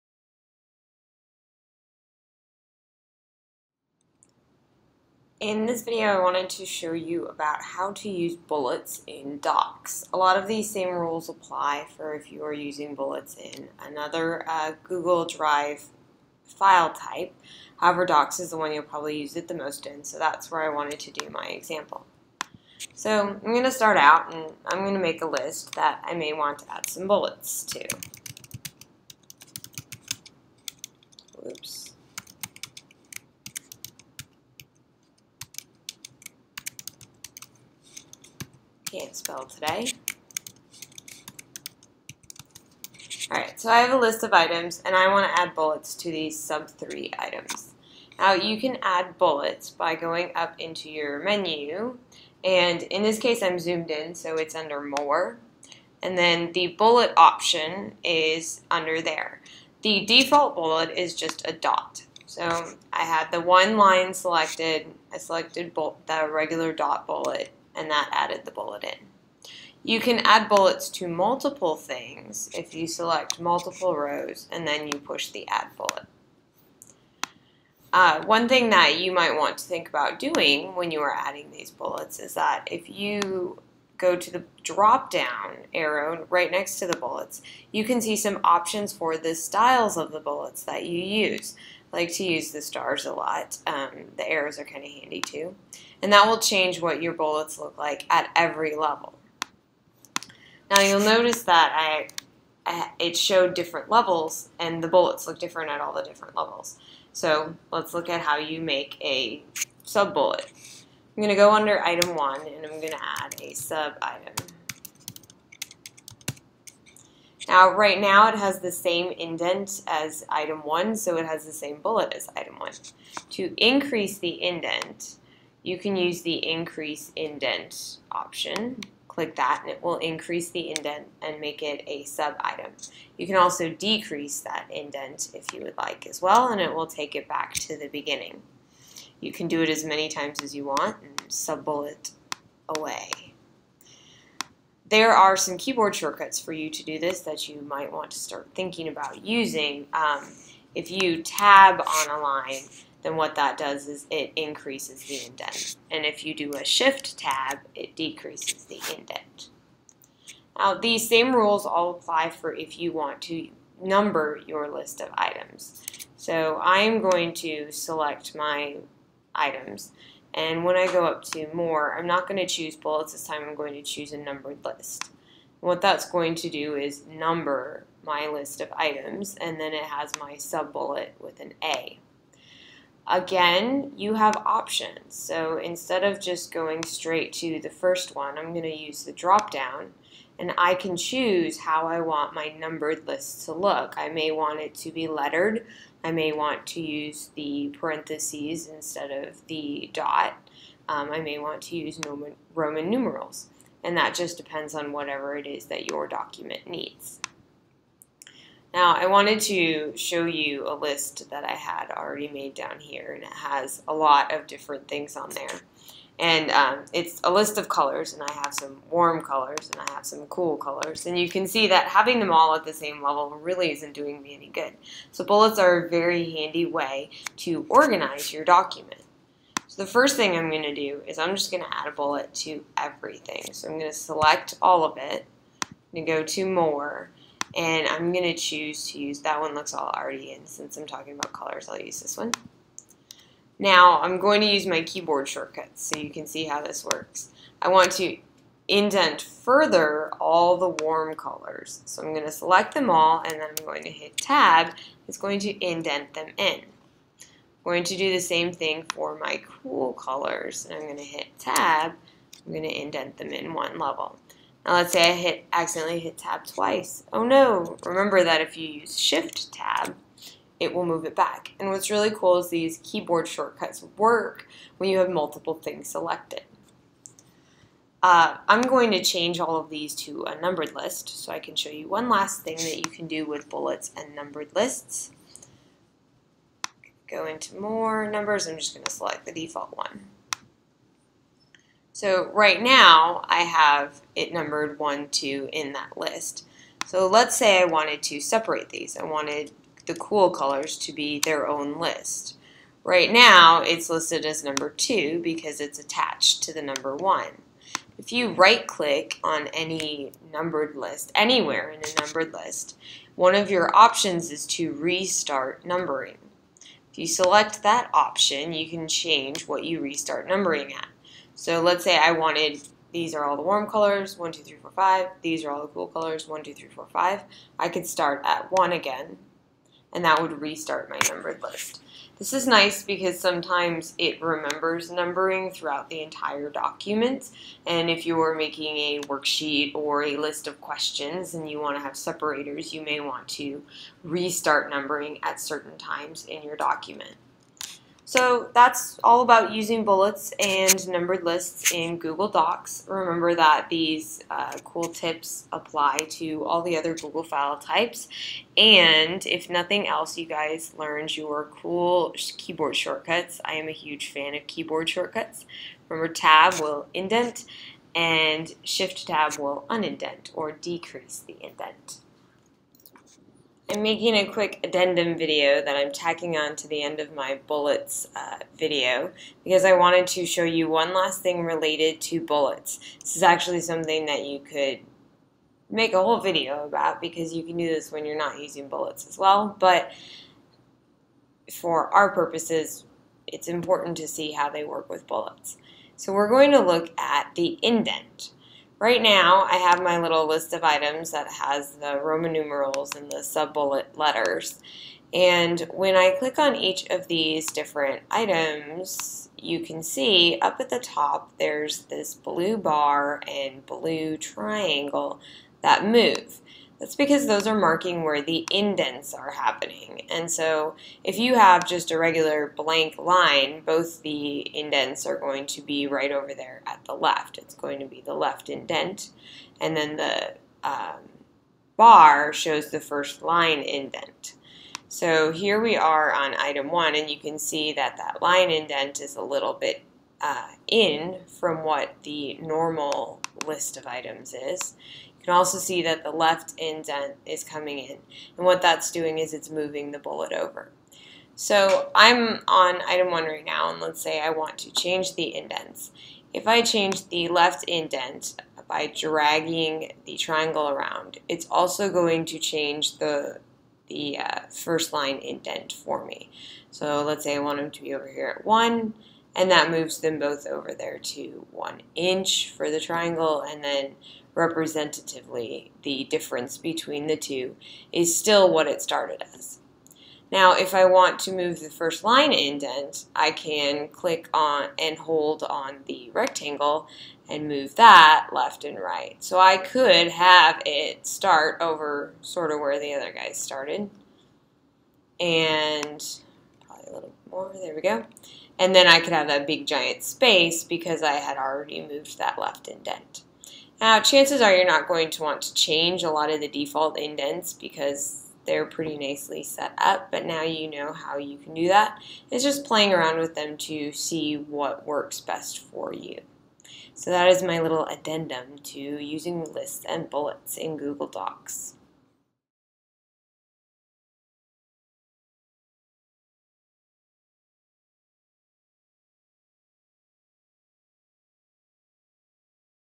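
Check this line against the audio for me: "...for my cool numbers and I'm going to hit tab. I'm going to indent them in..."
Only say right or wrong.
wrong.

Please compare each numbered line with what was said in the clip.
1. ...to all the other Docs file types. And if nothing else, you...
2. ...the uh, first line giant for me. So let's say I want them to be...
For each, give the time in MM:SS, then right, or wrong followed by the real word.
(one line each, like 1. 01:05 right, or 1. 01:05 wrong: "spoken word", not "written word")
1. 05:56 wrong: "Google", not "Docs"
2. 07:43 wrong: "indent", not "giant".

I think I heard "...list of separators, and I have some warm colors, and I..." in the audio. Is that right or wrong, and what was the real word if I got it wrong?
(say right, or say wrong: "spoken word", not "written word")
wrong: "colors", not "separators".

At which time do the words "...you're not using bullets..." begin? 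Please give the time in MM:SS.
06:28.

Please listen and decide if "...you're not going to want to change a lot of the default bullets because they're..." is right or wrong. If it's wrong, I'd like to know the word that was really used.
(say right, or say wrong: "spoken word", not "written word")
wrong: "indents", not "bullets".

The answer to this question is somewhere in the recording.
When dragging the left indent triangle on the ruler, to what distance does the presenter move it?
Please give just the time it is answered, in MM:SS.
07:51.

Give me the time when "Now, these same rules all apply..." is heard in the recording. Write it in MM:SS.
02:40.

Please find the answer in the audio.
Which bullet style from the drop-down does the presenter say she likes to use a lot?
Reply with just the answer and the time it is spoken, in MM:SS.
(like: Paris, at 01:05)
stars, at 01:32.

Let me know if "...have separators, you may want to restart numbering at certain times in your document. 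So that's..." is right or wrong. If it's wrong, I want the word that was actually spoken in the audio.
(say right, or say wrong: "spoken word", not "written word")
right.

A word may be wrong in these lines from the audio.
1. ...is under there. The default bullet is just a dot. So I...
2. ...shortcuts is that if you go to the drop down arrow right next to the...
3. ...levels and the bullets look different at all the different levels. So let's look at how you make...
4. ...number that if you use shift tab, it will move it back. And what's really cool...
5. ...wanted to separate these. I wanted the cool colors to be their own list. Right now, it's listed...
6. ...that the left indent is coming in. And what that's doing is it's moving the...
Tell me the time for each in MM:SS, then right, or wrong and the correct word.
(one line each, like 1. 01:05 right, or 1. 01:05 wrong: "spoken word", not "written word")
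1. 00:58 right
2. 01:21 wrong: "bullets", not "shortcuts"
3. 01:43 right
4. 04:27 wrong: "remember", not "number"
5. 04:57 right
6. 07:25 right.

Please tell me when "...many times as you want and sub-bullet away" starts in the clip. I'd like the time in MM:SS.
02:19.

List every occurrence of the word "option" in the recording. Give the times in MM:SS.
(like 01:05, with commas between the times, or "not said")
00:57, 01:28, 02:08, 03:04, 05:13, 05:17.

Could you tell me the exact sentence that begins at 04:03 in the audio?
Now I'm going to use my keyboard shortcuts so you can see how this works.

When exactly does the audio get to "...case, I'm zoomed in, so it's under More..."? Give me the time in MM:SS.
00:53.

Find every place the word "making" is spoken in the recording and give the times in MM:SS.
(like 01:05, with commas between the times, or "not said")
05:38, 06:13.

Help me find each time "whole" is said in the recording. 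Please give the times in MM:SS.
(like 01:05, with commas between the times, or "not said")
06:26.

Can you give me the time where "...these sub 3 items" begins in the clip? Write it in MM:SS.
00:46.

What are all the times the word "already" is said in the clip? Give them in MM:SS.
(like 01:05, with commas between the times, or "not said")
03:31, 03:59, 08:21.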